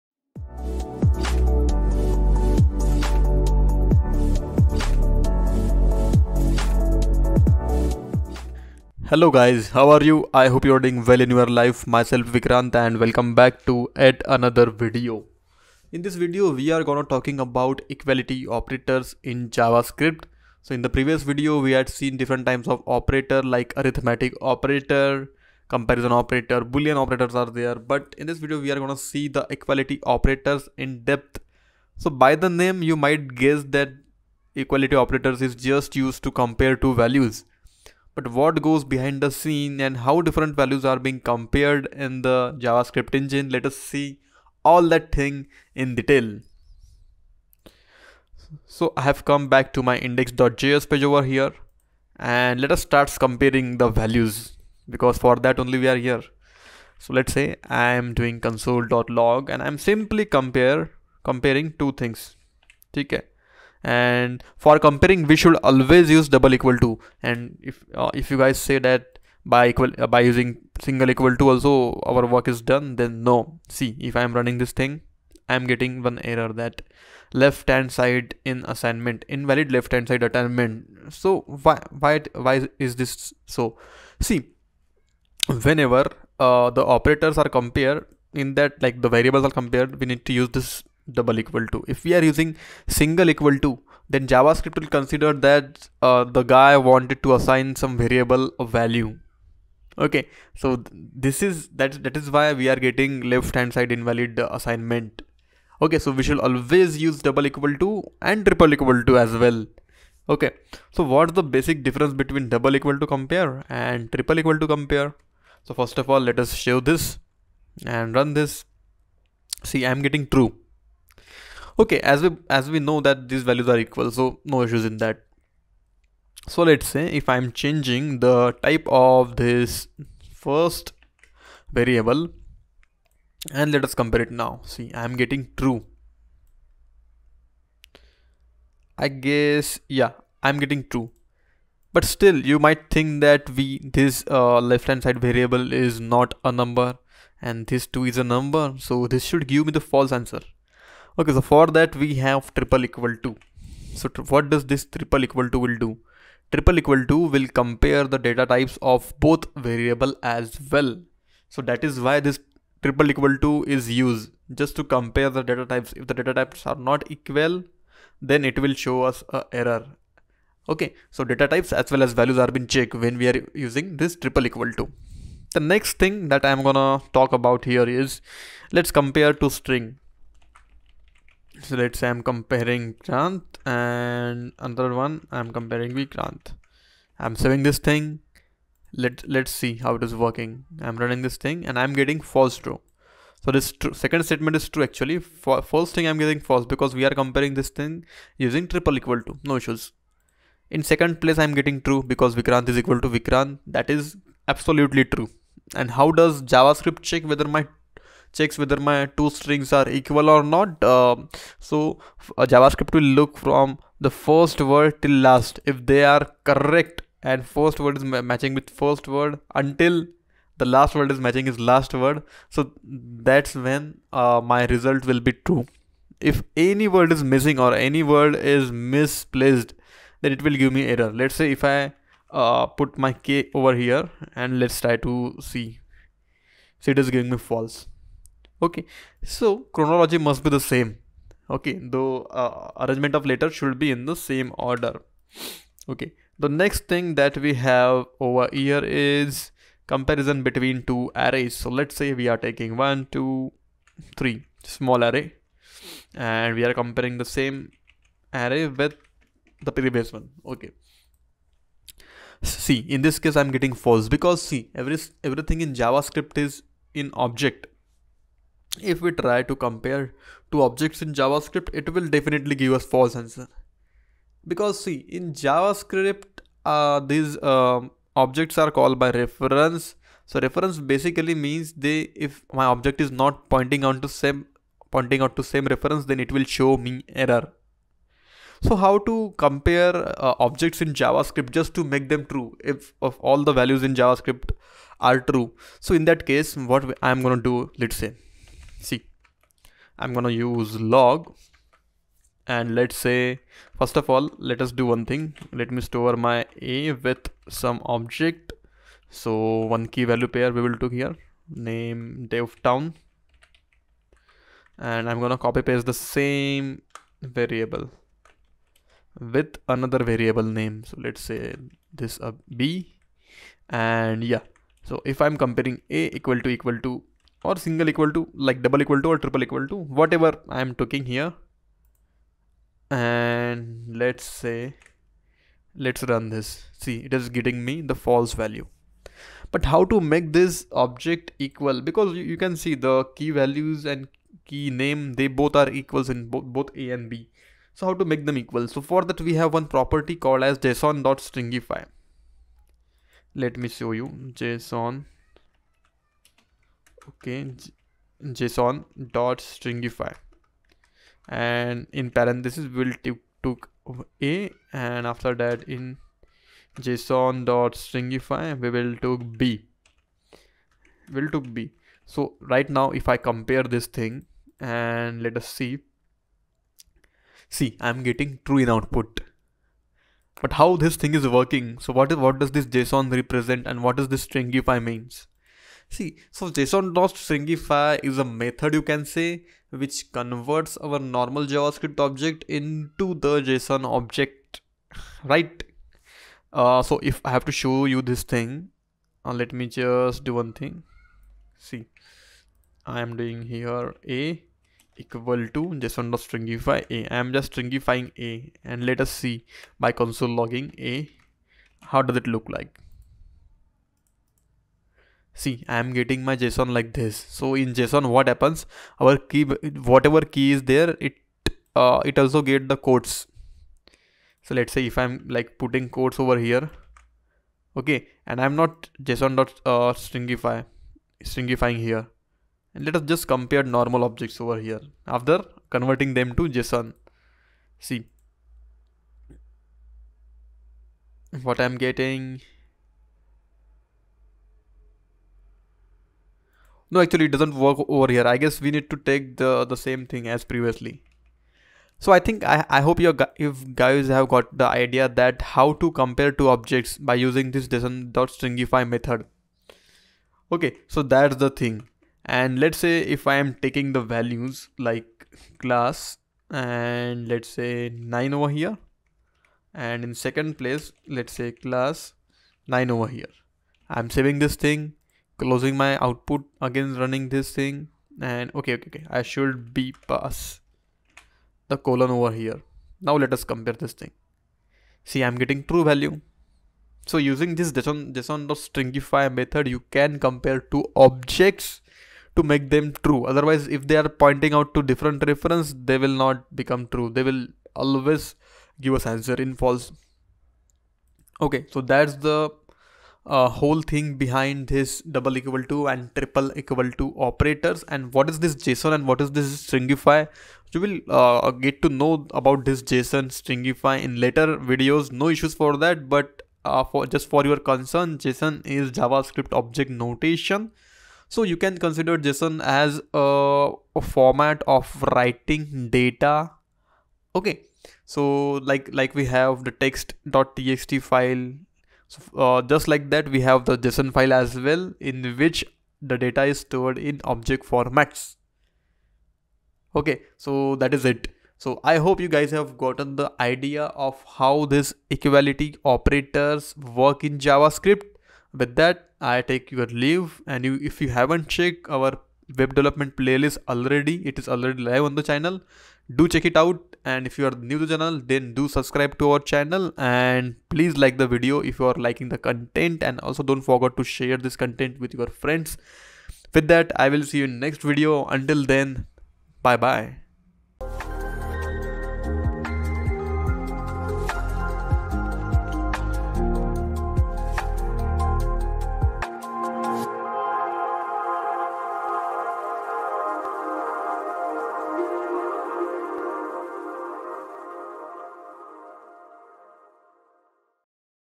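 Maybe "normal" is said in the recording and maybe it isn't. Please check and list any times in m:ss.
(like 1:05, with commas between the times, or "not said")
6:30, 7:13.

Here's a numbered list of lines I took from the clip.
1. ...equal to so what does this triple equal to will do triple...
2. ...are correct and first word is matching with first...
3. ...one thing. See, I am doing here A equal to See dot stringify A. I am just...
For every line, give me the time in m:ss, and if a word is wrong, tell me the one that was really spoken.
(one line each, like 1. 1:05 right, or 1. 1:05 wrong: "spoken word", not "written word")
1. 2:32 right
2. 3:36 right
3. 6:40 wrong: "JSON", not "See".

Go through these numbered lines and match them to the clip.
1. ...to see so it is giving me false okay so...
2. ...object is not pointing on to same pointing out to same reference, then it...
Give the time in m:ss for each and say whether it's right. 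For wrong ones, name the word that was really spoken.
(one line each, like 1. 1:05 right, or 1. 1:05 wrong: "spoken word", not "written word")
1. 3:54 right
2. 4:42 right.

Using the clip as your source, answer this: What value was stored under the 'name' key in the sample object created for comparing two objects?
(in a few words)
dev town.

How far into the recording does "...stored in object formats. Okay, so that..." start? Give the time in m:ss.
8:56.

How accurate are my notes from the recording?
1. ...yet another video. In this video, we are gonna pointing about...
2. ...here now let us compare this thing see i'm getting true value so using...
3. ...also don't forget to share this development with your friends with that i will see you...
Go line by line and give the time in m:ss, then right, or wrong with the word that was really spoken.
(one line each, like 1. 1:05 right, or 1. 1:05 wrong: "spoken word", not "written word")
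1. 0:13 wrong: "talking", not "pointing"
2. 8:02 right
3. 9:23 wrong: "content", not "development".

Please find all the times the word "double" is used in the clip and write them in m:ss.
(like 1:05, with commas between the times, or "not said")
1:06, 1:31, 1:47, 1:52, 5:28, 8:25.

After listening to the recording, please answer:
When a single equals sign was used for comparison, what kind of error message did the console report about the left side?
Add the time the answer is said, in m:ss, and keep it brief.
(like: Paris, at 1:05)
Invalid left hand side assignment, at 1:19.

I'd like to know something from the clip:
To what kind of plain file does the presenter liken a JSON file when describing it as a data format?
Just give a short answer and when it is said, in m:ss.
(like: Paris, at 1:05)
text.txt file, at 8:49.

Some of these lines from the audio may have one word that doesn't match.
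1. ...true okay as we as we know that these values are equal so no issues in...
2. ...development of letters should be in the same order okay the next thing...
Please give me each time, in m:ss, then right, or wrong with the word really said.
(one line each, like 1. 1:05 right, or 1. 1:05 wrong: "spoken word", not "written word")
1. 2:00 right
2. 4:02 wrong: "arrangement", not "development".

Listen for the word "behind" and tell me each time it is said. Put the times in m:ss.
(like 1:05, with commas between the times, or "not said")
0:38, 8:24.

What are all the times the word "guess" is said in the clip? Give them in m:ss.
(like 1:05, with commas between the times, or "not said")
0:33, 2:19, 7:28.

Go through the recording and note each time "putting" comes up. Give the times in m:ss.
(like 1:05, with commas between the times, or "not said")
7:05.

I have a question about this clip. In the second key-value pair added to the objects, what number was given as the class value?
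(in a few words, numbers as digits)
9.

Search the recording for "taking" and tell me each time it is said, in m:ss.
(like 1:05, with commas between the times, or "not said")
4:12, 5:30, 7:43.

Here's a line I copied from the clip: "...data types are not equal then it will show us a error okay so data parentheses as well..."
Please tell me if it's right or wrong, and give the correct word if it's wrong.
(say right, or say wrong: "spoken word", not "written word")
wrong: "types", not "parentheses".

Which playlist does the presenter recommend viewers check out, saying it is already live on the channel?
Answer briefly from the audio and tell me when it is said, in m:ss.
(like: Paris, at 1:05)
Web development playlist, at 9:12.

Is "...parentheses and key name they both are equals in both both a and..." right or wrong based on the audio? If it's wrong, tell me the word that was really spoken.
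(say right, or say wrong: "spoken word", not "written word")
wrong: "values", not "parentheses".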